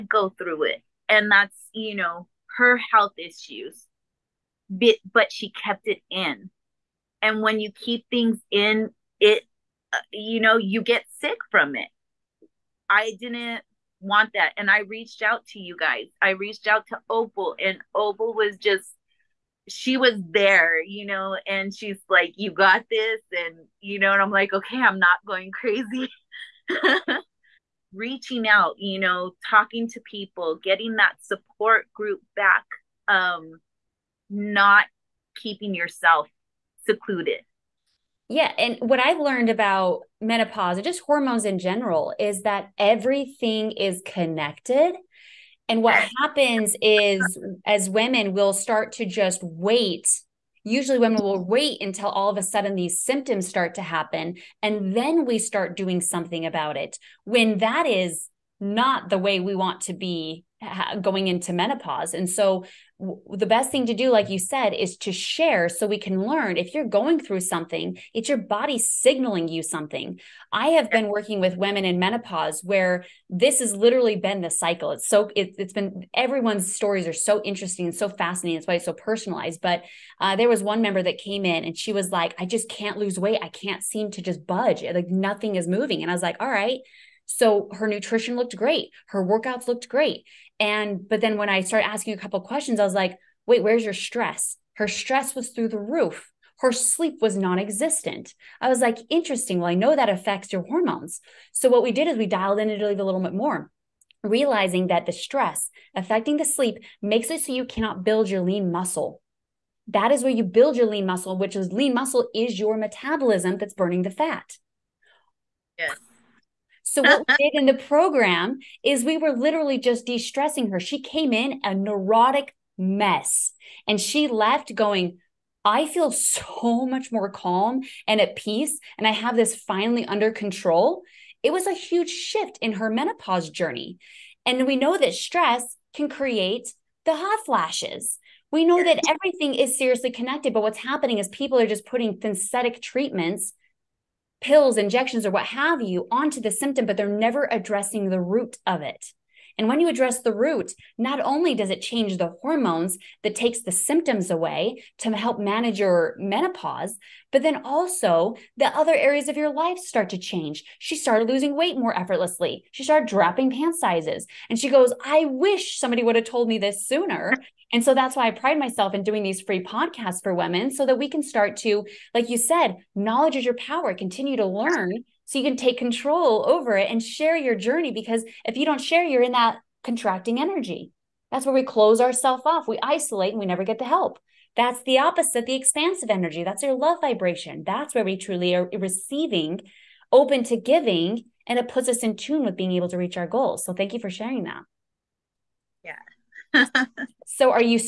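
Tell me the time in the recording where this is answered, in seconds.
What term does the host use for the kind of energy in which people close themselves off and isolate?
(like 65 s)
179 s.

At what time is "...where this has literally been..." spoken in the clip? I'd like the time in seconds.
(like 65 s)
72 s.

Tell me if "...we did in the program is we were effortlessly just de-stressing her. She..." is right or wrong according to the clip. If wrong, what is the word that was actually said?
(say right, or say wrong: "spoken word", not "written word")
wrong: "literally", not "effortlessly".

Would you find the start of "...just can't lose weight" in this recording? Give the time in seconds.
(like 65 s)
82 s.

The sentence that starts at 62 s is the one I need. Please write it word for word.
And so the best thing to do, like you said, is to share so we can learn.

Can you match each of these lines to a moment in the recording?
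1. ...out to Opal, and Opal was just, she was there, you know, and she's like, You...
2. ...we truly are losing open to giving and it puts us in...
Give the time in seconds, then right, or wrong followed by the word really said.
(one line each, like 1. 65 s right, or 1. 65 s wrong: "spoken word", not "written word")
1. 16 s right
2. 188 s wrong: "receiving", not "losing".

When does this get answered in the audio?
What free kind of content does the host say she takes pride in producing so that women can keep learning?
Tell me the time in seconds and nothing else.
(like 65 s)
169 s.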